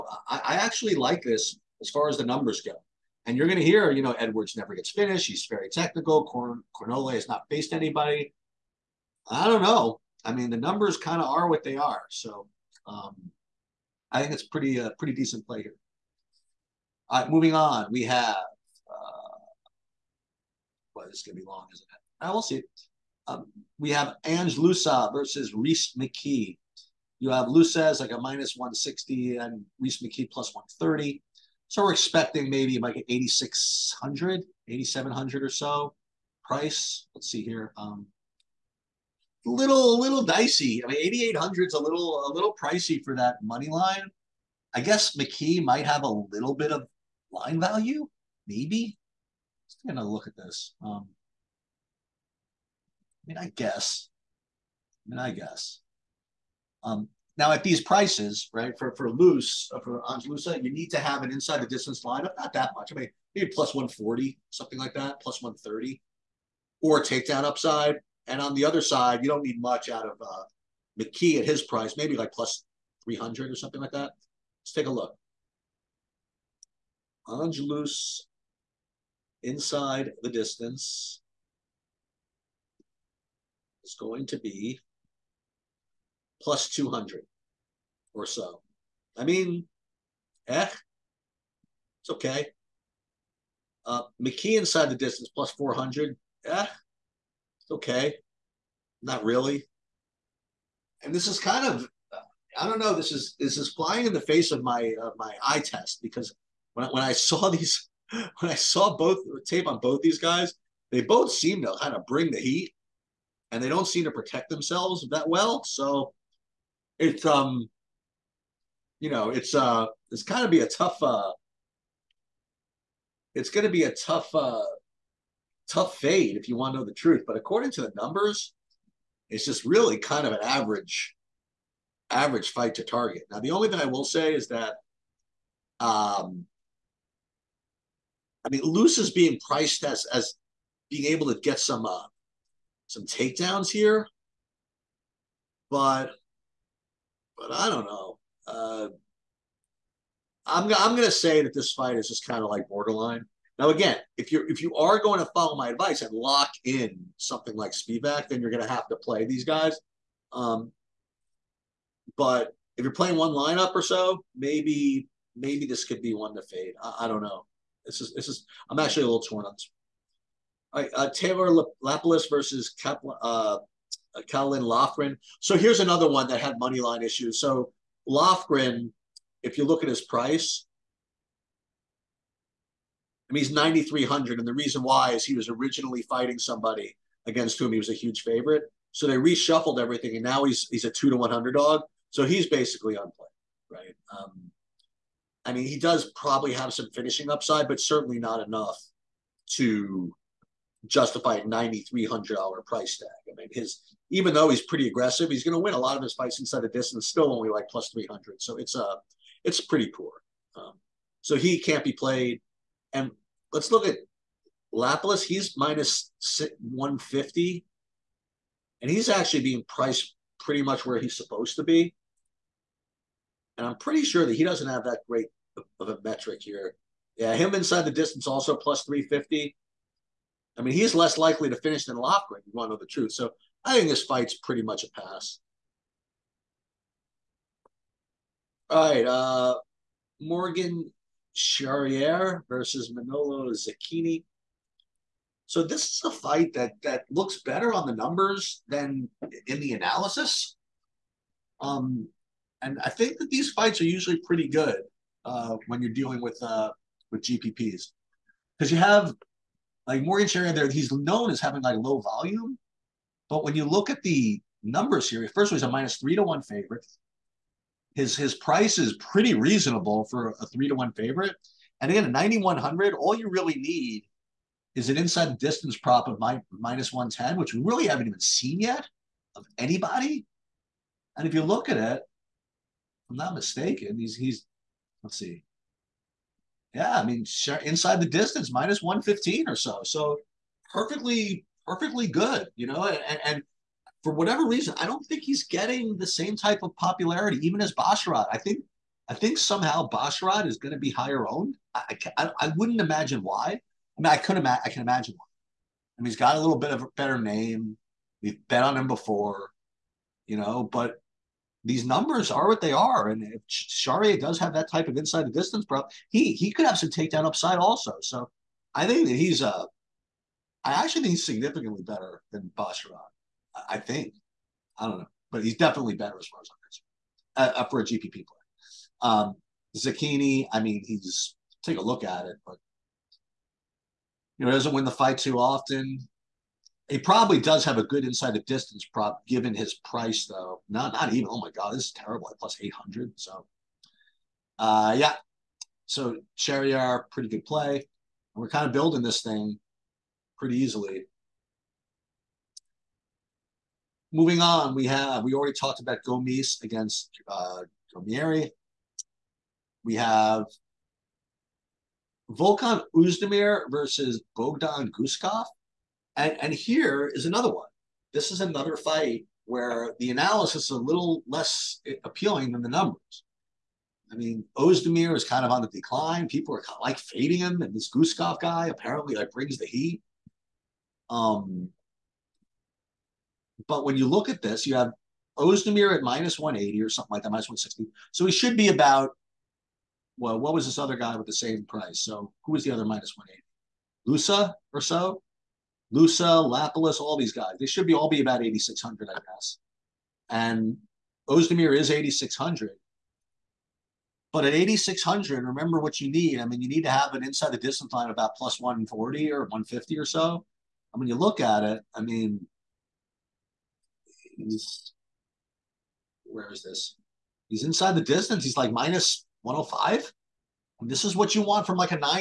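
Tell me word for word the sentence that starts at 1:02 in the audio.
I mean, maybe plus 140, something like that, plus 130, or takedown upside.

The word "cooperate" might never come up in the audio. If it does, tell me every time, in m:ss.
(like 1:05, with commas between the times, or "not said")
not said.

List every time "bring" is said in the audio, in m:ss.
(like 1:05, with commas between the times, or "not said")
1:52, 6:19.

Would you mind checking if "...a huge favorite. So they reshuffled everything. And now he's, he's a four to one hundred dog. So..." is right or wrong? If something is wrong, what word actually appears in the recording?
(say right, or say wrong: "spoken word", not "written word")
wrong: "two", not "four".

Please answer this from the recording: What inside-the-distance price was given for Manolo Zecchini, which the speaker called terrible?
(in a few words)
+800.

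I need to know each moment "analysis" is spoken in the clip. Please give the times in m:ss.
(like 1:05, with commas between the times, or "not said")
4:09, 6:10.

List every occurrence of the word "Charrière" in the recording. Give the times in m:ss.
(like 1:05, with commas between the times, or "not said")
4:01, 5:46.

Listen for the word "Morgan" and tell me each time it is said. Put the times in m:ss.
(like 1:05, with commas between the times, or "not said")
4:00, 4:20.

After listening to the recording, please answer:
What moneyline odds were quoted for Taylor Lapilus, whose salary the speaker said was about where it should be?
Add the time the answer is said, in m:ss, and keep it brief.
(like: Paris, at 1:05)
-150, at 3:35.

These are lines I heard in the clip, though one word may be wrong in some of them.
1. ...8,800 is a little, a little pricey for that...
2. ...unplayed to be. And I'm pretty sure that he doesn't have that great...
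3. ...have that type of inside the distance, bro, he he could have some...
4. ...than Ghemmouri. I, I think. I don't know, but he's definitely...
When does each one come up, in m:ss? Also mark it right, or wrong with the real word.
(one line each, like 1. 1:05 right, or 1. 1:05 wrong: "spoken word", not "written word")
1. 0:41 right
2. 3:41 wrong: "supposed", not "unplayed"
3. 5:14 right
4. 5:22 wrong: "Basharat", not "Ghemmouri".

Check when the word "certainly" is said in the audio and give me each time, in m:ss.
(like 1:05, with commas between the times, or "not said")
3:17.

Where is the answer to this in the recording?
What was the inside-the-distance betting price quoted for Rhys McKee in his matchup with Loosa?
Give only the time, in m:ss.
1:35.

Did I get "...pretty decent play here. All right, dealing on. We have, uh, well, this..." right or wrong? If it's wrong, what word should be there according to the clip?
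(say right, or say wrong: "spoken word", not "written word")
wrong: "moving", not "dealing".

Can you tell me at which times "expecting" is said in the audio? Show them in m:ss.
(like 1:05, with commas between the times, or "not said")
0:31.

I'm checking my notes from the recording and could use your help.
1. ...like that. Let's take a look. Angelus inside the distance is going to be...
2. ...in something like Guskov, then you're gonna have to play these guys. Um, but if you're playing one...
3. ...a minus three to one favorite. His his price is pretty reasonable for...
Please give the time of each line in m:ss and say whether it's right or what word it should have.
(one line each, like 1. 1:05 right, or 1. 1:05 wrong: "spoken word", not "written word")
1. 1:13 right
2. 2:36 wrong: "Spivak", not "Guskov"
3. 4:25 right.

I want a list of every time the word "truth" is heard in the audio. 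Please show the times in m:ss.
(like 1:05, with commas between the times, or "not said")
2:06, 3:52.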